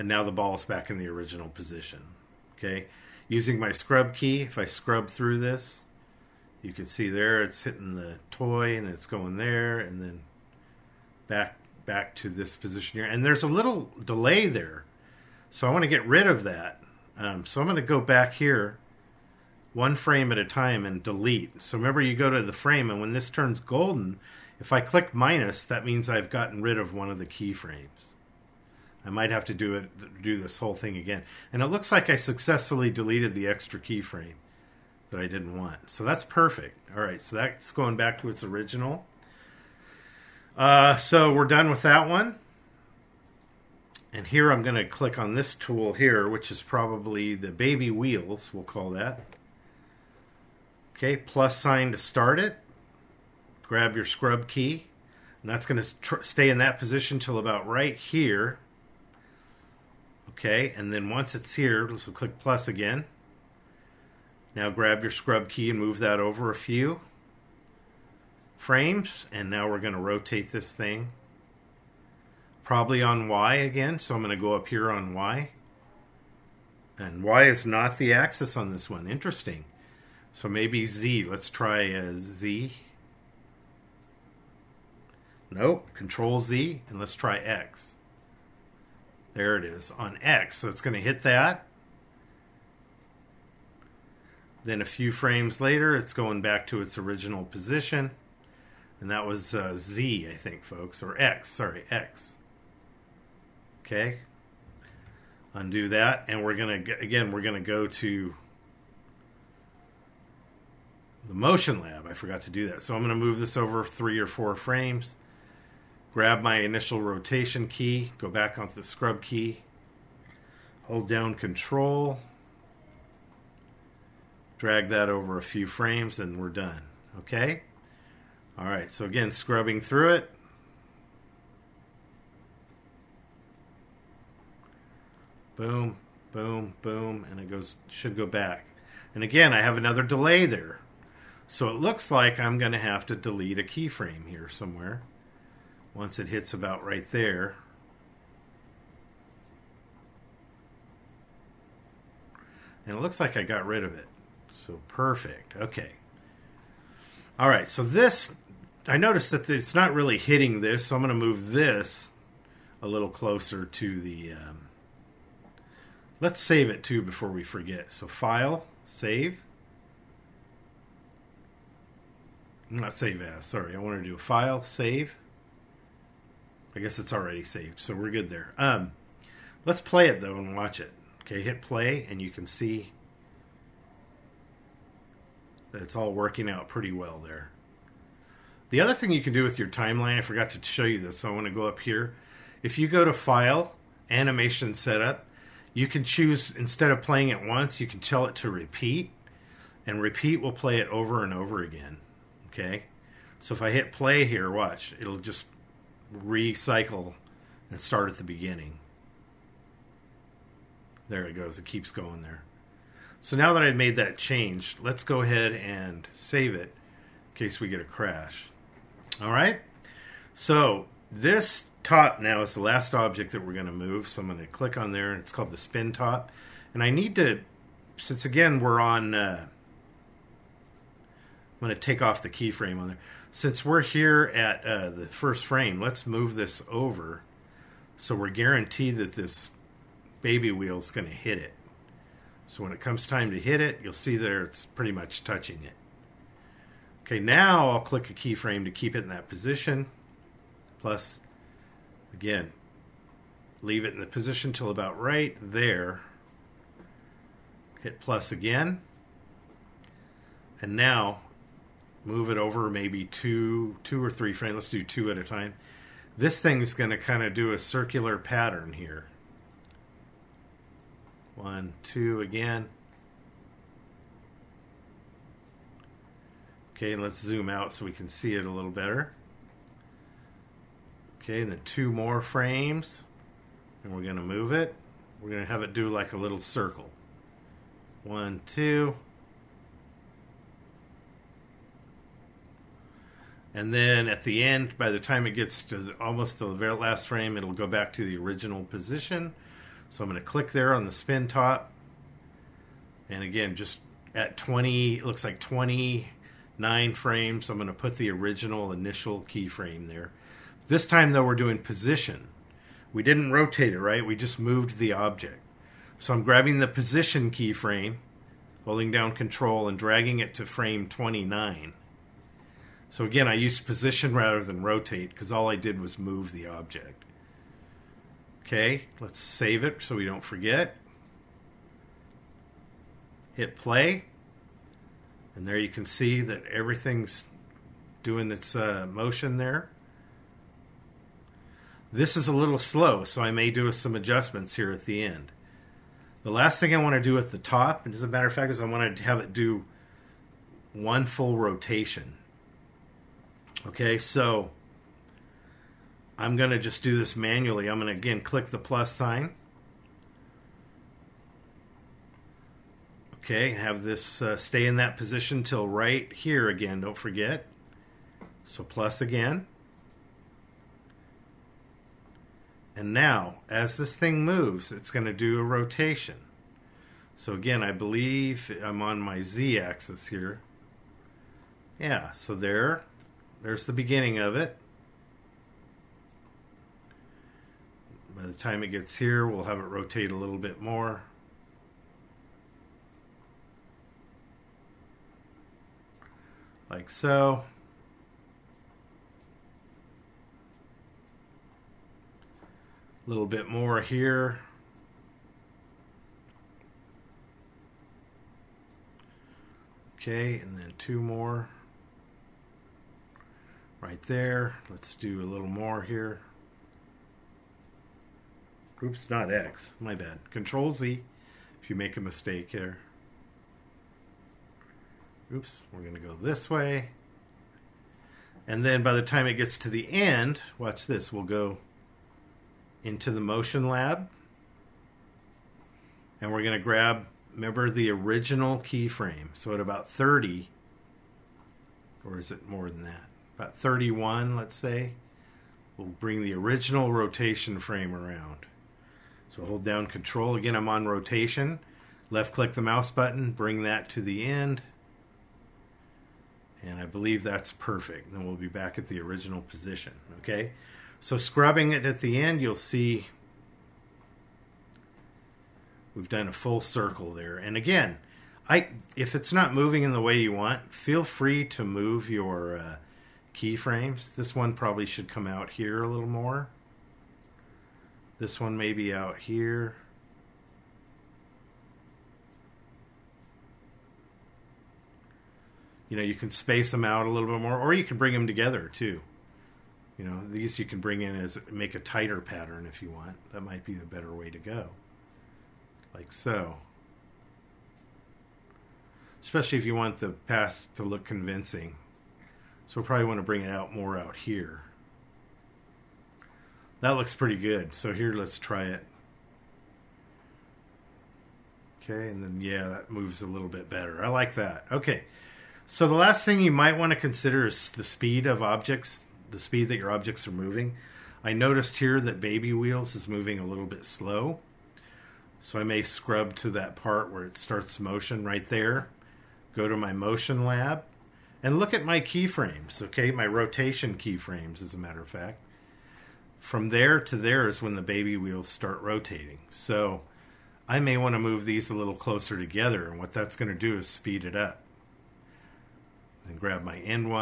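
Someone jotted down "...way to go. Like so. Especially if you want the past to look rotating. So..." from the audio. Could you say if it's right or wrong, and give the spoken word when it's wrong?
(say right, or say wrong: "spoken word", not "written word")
wrong: "convincing", not "rotating".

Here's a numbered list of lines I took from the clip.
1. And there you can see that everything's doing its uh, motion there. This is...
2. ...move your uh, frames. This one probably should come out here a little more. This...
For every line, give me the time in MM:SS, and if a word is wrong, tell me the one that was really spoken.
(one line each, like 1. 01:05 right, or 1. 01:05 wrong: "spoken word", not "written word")
1. 05:35 right
2. 07:51 wrong: "keyframes", not "frames".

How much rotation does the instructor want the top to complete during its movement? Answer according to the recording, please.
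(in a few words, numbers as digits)
one full rotation.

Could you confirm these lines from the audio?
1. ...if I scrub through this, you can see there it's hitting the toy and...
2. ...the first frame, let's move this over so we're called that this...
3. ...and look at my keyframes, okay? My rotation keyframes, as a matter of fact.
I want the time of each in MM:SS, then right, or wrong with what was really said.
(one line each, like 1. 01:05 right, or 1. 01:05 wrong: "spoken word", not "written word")
1. 00:04 right
2. 03:54 wrong: "guaranteed", not "called"
3. 08:51 right.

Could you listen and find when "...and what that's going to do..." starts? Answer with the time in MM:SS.
09:02.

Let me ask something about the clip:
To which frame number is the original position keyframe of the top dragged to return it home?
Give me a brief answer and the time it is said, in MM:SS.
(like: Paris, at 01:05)
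29, at 05:20.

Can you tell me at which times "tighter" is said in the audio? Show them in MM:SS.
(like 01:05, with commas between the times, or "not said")
08:11.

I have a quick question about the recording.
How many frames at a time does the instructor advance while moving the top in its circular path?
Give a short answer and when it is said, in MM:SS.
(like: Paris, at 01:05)
2, at 04:24.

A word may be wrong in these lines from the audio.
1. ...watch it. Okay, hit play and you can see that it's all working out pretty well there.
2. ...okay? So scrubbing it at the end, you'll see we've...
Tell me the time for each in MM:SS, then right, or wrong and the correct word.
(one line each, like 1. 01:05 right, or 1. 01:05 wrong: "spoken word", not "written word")
1. 03:00 right
2. 07:40 right.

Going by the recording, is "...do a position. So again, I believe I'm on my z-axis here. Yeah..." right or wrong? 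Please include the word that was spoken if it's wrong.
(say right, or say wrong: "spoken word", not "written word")
wrong: "rotation", not "position".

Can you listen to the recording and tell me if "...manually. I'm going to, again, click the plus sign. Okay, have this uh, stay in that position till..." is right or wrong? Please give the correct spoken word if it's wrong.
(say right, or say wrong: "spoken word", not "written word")
right.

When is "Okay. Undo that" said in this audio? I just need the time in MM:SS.
01:43.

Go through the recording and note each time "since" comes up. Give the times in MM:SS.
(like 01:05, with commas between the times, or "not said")
03:47, 03:53.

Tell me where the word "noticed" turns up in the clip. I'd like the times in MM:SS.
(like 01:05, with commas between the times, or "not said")
02:38, 08:41.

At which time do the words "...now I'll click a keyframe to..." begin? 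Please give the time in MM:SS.
04:07.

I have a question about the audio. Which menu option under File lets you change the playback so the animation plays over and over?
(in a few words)
Animation Setup.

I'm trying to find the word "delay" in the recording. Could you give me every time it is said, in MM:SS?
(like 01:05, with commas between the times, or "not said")
00:14, 02:20.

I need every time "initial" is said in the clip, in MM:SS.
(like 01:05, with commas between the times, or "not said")
01:56, 05:08.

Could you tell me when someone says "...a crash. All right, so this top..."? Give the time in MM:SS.
03:37.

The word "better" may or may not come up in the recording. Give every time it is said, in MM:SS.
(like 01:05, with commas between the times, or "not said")
04:38, 08:13, 08:33.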